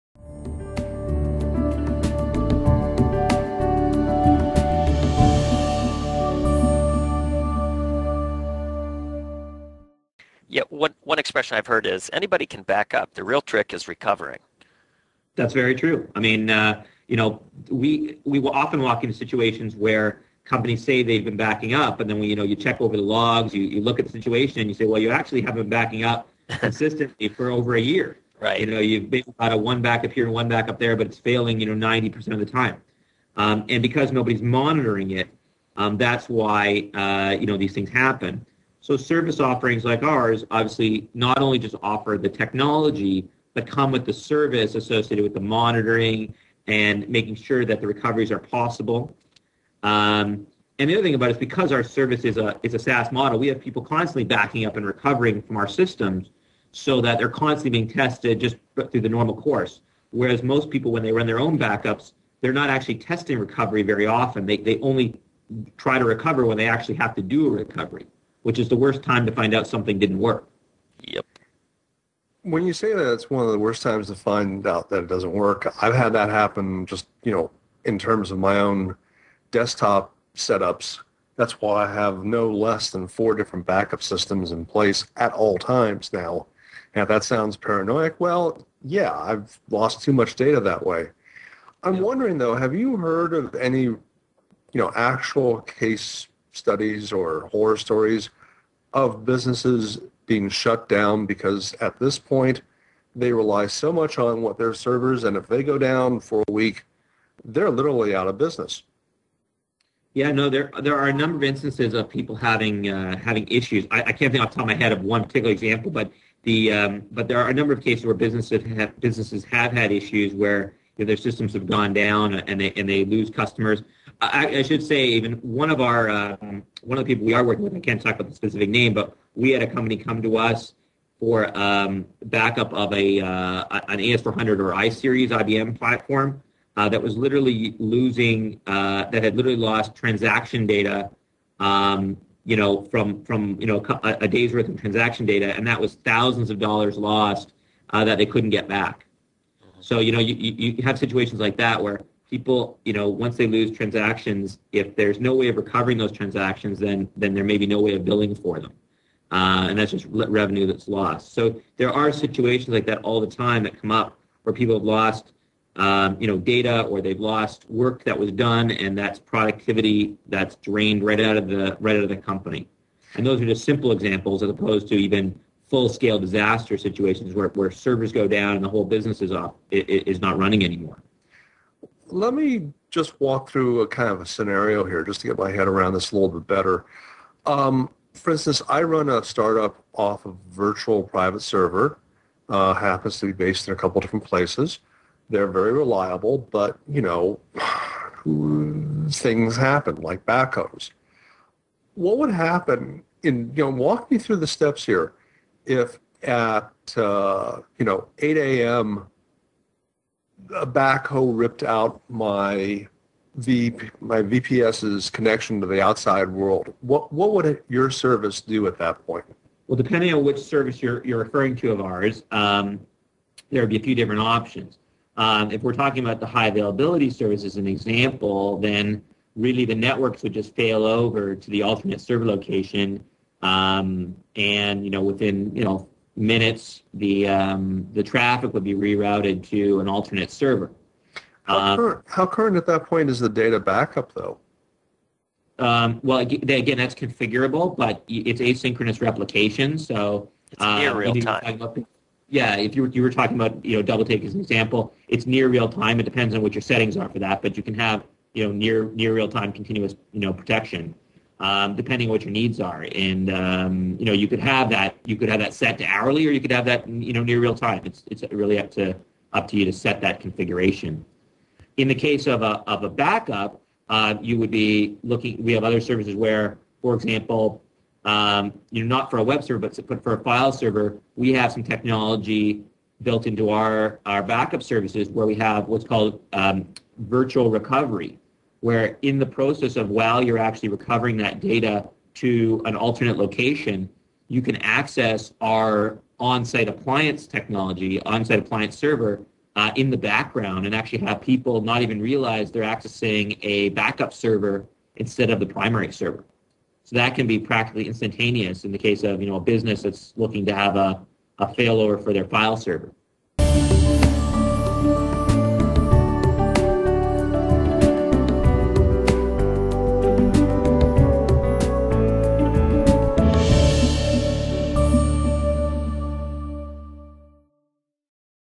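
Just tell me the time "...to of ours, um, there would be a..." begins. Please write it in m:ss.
3:41.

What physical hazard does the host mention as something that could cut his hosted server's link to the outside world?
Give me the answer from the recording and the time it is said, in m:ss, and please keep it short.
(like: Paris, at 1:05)
backhoes, at 3:20.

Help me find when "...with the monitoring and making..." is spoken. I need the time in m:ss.
0:45.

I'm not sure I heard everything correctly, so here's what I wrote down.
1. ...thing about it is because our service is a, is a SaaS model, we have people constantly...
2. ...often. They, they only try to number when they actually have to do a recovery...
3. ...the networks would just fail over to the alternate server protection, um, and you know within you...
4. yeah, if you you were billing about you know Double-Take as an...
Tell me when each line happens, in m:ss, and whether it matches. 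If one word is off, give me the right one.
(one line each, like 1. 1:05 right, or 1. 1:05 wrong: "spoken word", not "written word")
1. 0:51 right
2. 1:04 wrong: "recover", not "number"
3. 3:49 wrong: "location", not "protection"
4. 4:12 wrong: "talking", not "billing".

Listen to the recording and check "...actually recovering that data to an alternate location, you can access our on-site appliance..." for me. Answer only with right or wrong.
right.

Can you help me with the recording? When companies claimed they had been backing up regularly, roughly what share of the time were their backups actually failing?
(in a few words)
90%.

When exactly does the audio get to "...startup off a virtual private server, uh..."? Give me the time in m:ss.
3:09.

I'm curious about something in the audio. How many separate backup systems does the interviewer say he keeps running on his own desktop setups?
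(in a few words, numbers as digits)
4.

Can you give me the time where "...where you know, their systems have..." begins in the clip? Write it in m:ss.
2:00.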